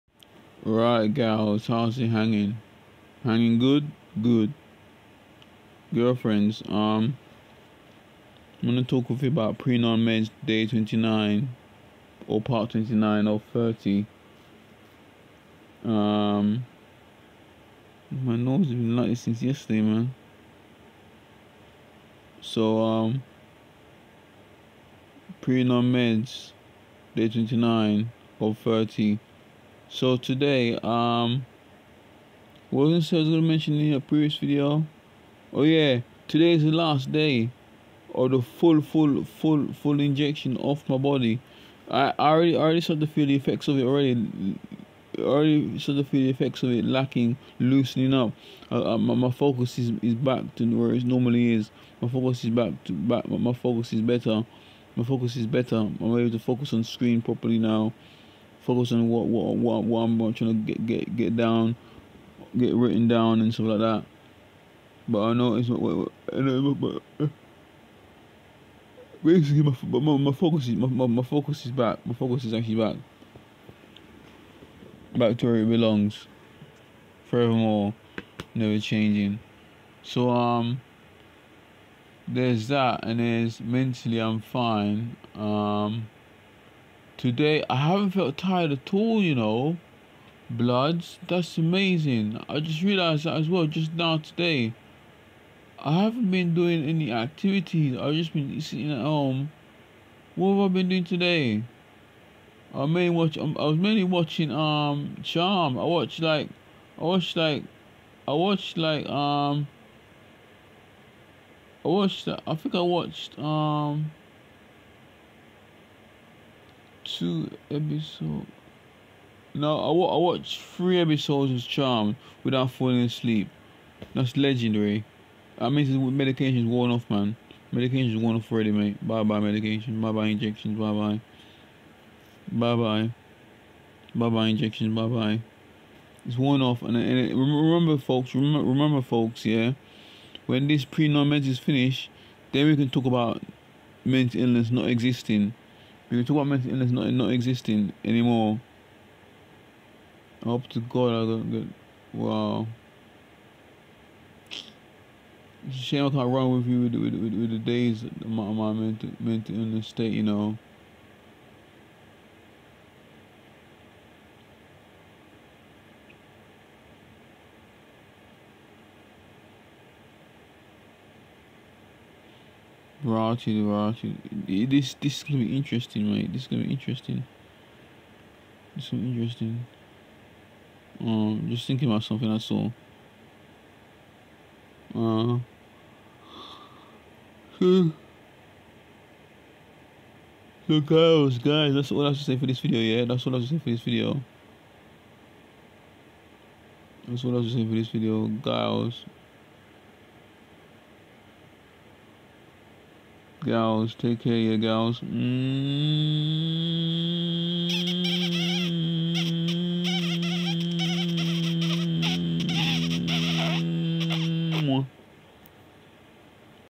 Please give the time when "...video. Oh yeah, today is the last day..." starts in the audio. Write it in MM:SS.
00:34.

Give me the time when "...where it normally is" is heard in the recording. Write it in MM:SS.
00:50.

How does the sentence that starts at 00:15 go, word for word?
Um, my nose has been like this since yesterday, man.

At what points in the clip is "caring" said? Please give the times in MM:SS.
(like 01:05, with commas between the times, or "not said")
not said.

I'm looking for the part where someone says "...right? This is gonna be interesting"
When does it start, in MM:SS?
02:56.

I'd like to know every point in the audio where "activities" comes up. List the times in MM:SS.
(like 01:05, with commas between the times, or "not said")
01:37.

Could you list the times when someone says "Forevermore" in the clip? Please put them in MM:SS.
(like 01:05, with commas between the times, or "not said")
01:17.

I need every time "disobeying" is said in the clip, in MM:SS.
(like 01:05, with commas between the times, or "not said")
not said.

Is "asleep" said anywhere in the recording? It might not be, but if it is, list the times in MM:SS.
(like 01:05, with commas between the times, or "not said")
02:03.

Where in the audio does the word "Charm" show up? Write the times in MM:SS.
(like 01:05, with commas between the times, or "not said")
01:45, 02:01.